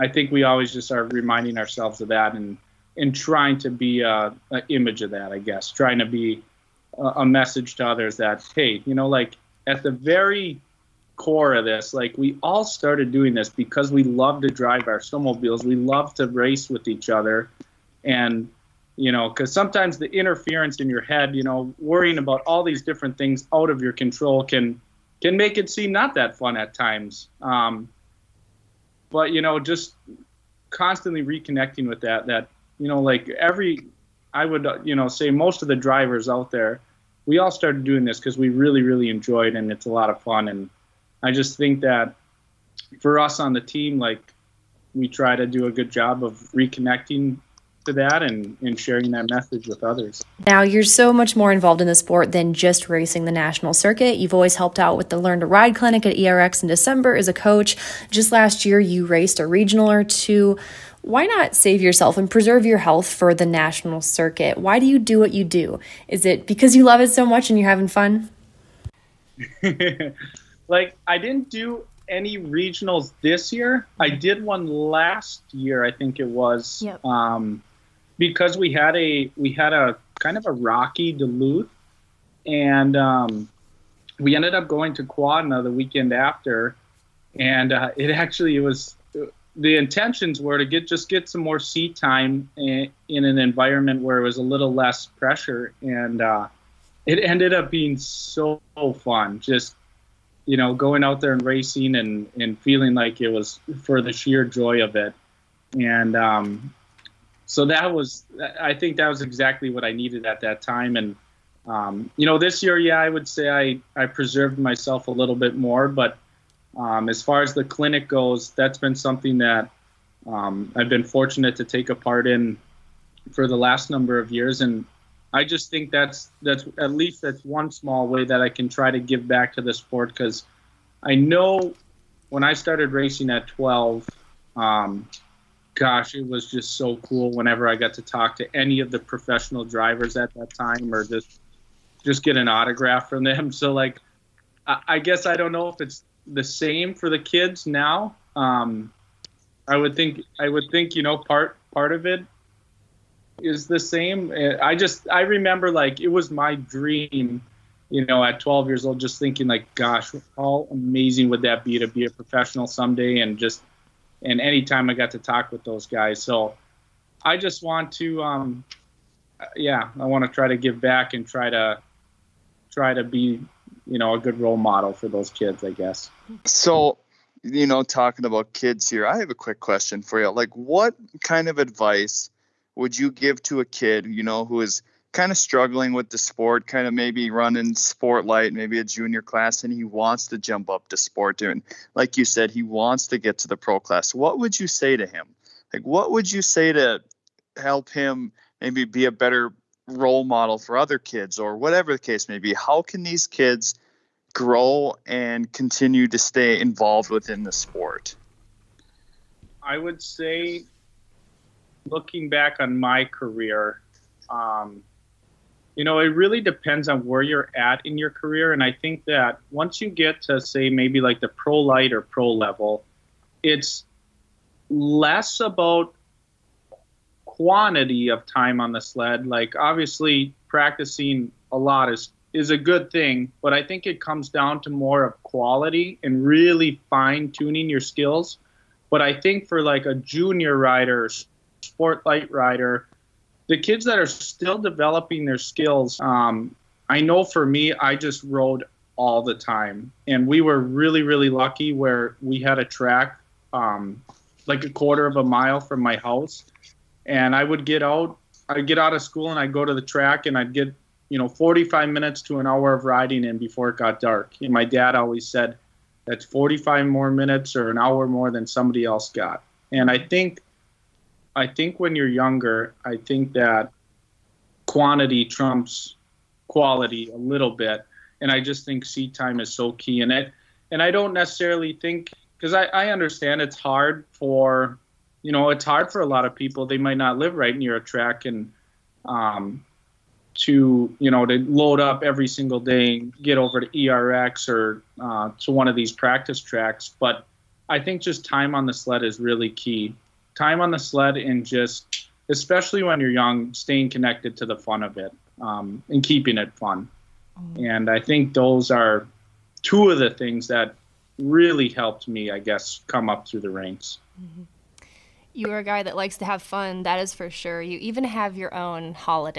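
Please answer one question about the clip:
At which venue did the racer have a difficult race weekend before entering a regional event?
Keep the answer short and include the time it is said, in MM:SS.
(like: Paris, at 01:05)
Duluth, at 01:21.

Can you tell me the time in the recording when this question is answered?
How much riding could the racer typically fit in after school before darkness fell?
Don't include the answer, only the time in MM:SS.
04:21.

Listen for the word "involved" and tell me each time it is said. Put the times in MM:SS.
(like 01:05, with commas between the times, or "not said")
00:51, 03:26.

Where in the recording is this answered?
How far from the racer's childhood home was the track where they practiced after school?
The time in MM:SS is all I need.
04:14.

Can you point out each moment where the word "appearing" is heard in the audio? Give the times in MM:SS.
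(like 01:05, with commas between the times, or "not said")
not said.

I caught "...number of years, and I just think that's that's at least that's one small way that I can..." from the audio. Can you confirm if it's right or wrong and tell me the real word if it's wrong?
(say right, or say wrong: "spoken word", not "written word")
right.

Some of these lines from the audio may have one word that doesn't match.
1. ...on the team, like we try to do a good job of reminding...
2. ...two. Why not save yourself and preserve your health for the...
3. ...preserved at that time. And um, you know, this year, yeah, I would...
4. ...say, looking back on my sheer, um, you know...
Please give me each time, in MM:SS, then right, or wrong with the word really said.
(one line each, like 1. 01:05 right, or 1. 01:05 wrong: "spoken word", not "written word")
1. 00:43 wrong: "reconnecting", not "reminding"
2. 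01:00 right
3. 01:49 wrong: "needed", not "preserved"
4. 03:30 wrong: "career", not "sheer".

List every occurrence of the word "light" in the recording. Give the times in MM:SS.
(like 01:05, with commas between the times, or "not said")
03:08, 03:41, 04:02.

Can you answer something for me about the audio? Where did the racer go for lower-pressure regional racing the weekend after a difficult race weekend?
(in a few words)
Quadna.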